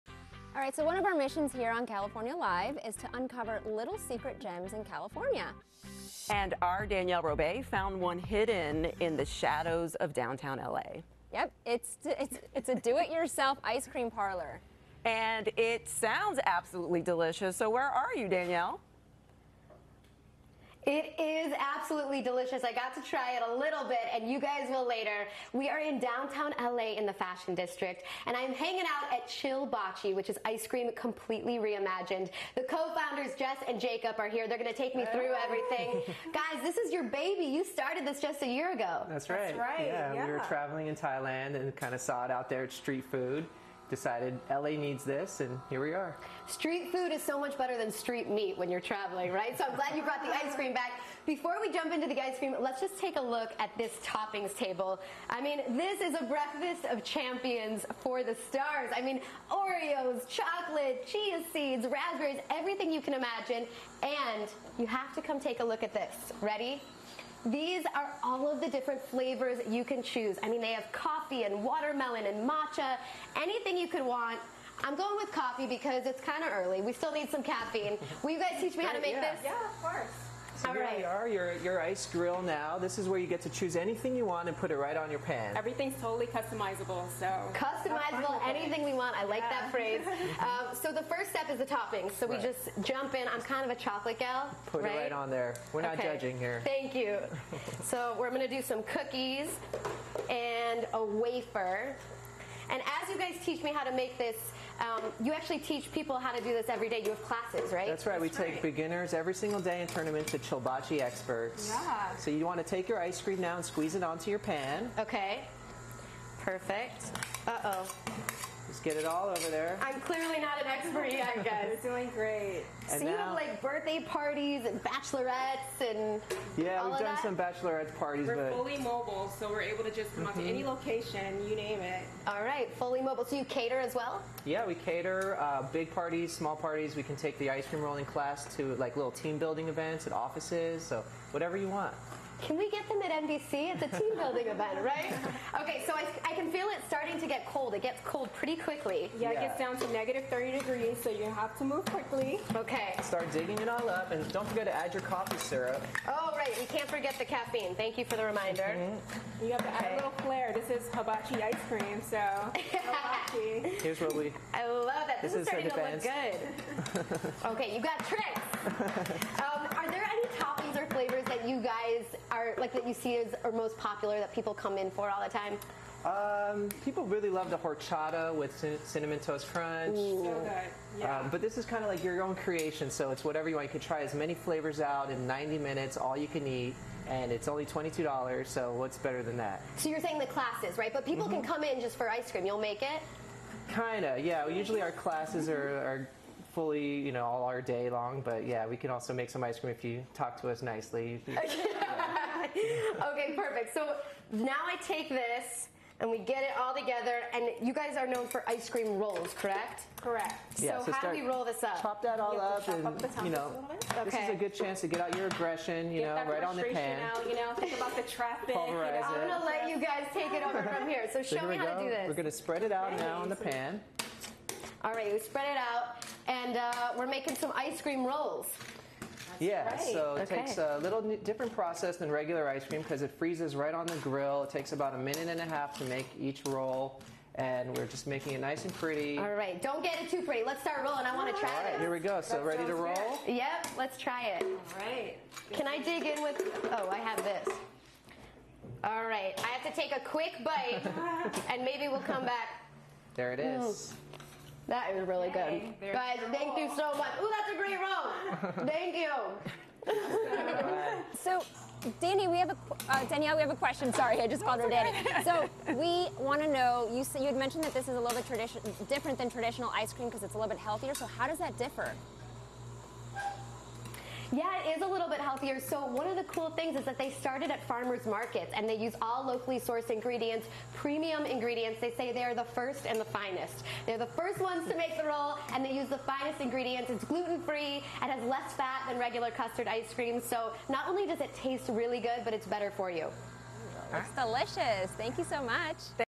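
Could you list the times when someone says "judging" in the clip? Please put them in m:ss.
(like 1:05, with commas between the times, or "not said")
1:36.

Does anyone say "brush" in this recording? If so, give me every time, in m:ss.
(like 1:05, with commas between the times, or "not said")
not said.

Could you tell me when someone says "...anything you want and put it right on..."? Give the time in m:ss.
1:23.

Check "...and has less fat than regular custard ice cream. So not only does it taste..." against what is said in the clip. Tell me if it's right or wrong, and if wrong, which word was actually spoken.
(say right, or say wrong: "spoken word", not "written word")
right.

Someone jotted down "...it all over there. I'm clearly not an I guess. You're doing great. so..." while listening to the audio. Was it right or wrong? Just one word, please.
right.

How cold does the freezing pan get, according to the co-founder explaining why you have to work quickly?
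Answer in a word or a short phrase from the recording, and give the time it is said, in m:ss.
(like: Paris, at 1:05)
-30 degrees, at 2:29.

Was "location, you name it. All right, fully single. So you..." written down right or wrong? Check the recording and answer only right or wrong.
wrong.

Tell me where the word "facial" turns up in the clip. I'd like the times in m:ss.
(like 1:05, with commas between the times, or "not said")
not said.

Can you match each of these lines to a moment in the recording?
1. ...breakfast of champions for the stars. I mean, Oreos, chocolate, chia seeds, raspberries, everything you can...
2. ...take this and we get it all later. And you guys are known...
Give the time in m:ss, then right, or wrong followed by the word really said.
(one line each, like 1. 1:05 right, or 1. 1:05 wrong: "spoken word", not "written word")
1. 0:56 right
2. 3:24 wrong: "together", not "later".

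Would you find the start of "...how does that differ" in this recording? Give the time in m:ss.
4:31.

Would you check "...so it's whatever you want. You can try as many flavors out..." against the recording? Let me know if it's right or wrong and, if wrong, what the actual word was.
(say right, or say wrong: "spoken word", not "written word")
right.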